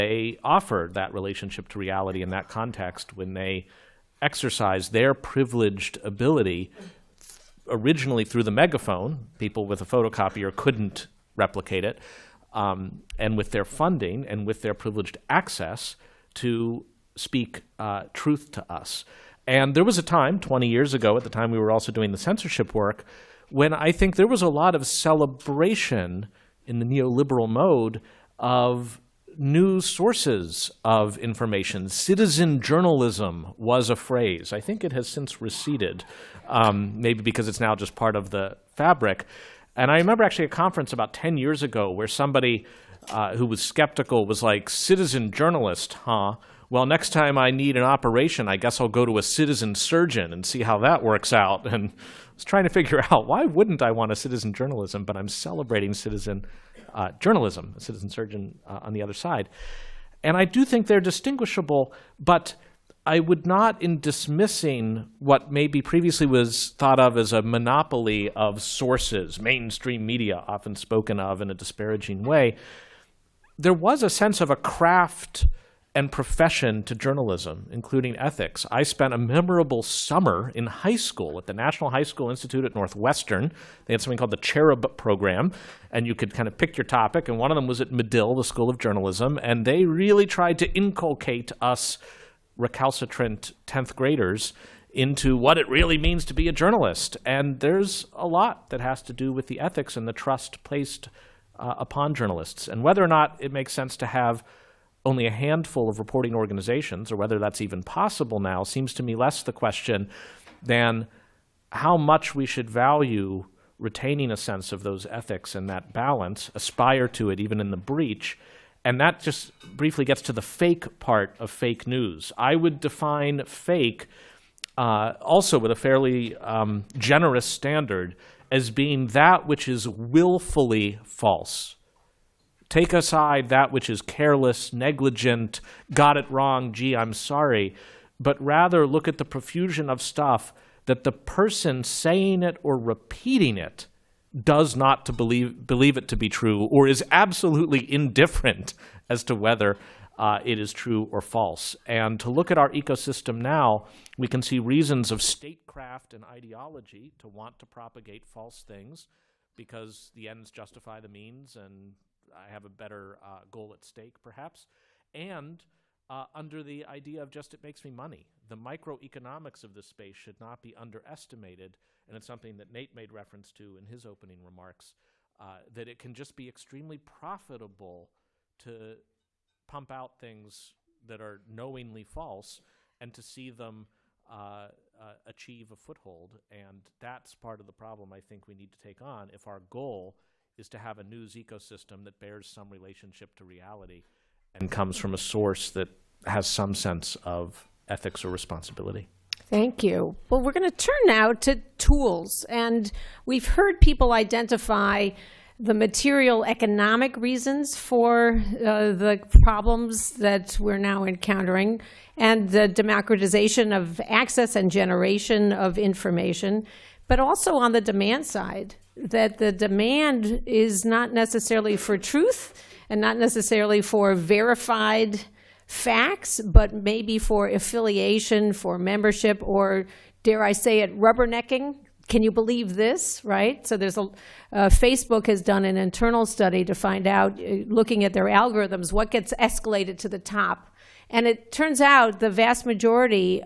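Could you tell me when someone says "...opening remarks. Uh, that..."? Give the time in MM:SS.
02:54.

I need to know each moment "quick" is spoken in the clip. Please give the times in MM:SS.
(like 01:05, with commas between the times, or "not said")
not said.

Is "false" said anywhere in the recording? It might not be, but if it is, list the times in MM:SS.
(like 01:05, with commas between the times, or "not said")
02:11, 02:31, 02:38, 03:02.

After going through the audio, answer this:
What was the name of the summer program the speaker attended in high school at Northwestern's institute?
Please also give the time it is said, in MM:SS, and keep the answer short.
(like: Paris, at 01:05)
Cherub Program, at 01:24.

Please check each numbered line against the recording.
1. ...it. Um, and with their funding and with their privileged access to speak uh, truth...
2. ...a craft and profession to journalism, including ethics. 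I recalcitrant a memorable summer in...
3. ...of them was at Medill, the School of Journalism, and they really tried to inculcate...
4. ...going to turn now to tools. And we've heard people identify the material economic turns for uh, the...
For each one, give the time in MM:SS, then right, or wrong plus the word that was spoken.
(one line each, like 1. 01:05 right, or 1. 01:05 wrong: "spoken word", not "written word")
1. 00:11 right
2. 01:14 wrong: "spent", not "recalcitrant"
3. 01:27 right
4. 03:20 wrong: "reasons", not "turns".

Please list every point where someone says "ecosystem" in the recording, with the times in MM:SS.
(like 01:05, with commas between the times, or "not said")
02:32, 03:11.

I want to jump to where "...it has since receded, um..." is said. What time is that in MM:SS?
00:34.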